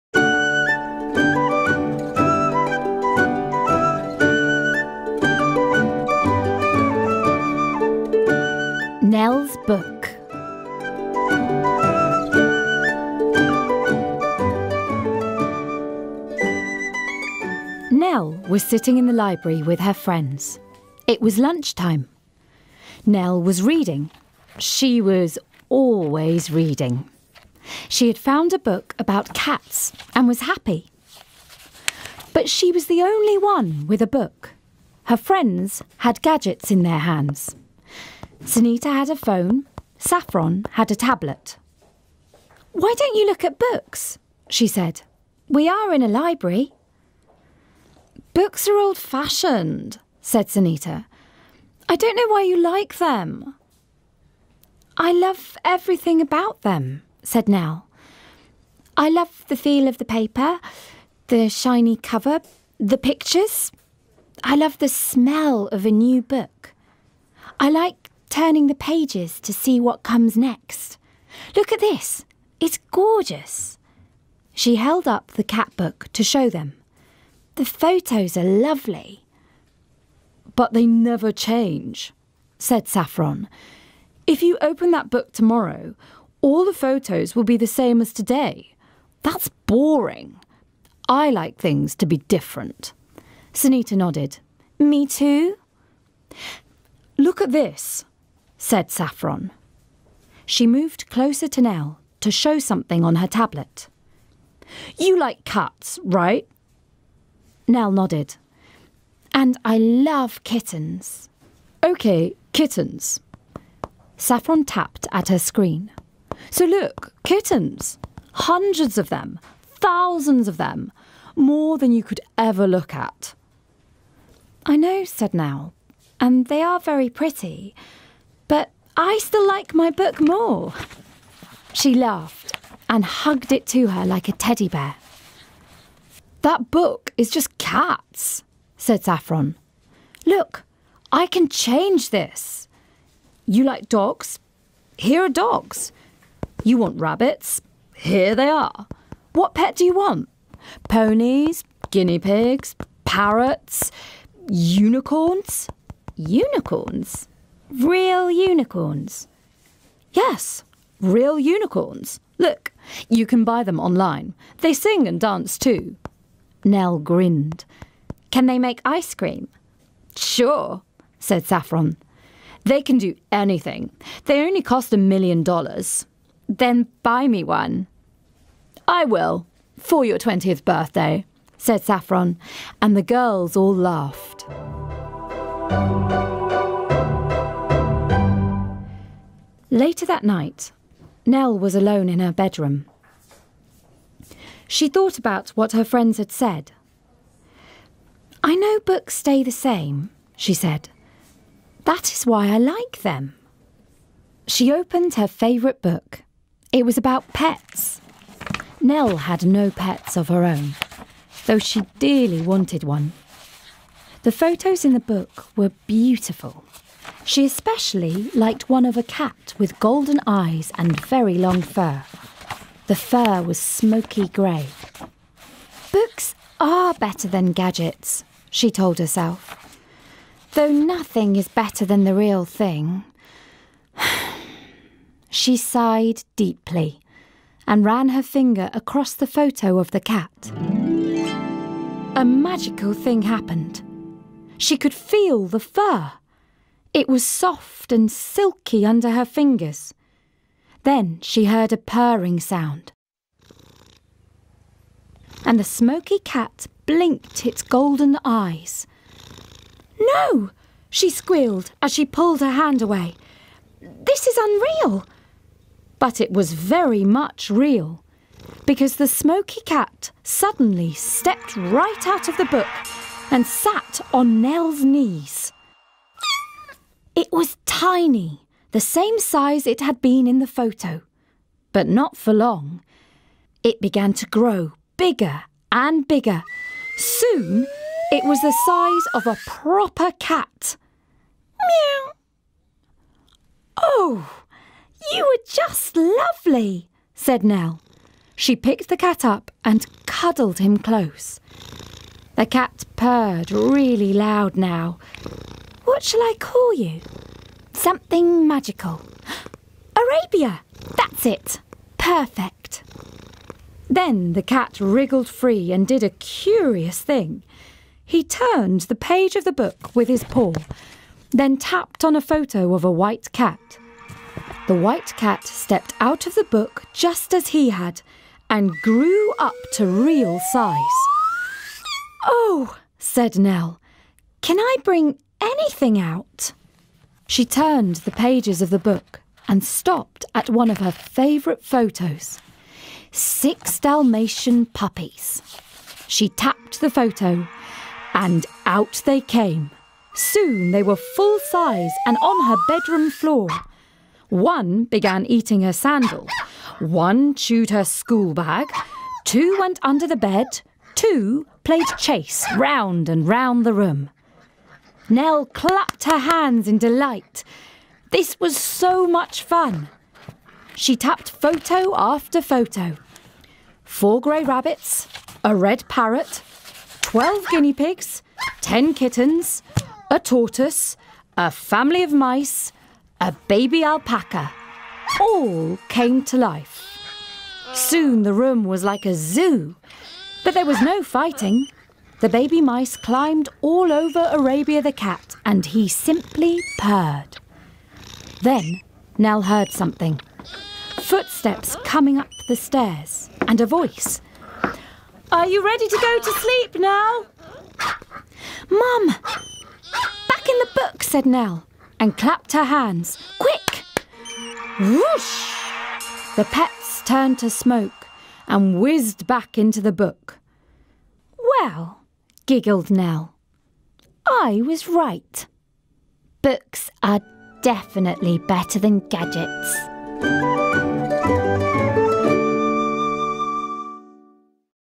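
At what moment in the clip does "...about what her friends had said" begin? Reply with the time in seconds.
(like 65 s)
195 s.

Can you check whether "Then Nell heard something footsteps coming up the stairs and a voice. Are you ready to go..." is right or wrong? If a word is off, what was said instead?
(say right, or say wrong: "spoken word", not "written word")
right.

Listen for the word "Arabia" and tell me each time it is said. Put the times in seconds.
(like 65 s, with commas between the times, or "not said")
309 s, 394 s.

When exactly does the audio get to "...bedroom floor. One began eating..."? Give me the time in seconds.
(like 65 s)
352 s.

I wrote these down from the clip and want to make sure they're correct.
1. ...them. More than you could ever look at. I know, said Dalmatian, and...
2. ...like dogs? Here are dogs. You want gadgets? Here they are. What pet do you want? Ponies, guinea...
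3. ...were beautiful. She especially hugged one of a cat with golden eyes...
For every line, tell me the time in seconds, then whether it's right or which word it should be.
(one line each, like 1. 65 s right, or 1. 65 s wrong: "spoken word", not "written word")
1. 120 s wrong: "Nell", not "Dalmatian"
2. 143 s wrong: "rabbits", not "gadgets"
3. 215 s wrong: "liked", not "hugged".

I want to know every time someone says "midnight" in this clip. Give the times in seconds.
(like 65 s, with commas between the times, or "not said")
not said.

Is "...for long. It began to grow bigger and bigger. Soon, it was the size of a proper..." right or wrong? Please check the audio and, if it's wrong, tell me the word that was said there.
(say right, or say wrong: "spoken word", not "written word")
right.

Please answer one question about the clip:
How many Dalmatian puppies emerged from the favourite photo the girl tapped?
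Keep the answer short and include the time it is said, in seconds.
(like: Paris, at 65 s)
6, at 343 s.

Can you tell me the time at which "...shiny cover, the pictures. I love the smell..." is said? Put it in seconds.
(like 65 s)
61 s.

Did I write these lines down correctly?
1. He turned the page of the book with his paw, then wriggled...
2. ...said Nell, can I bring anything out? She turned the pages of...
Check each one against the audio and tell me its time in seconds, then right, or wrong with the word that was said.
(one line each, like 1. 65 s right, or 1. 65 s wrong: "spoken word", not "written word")
1. 318 s wrong: "tapped", not "wriggled"
2. 332 s right.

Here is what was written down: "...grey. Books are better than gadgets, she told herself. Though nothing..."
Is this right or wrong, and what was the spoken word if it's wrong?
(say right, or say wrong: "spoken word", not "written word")
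right.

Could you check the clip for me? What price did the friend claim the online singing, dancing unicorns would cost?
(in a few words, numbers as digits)
a million dollars.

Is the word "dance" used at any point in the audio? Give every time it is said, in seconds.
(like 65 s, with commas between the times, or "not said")
165 s.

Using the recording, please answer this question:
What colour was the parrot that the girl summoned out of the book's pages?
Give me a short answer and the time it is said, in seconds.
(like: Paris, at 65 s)
red, at 375 s.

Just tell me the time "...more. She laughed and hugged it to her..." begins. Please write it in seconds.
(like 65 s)
130 s.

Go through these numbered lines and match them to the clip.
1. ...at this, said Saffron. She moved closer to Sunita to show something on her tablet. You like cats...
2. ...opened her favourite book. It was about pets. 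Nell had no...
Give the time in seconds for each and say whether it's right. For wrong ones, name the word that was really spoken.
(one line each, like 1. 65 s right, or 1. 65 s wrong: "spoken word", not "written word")
1. 97 s wrong: "Nell", not "Sunita"
2. 204 s right.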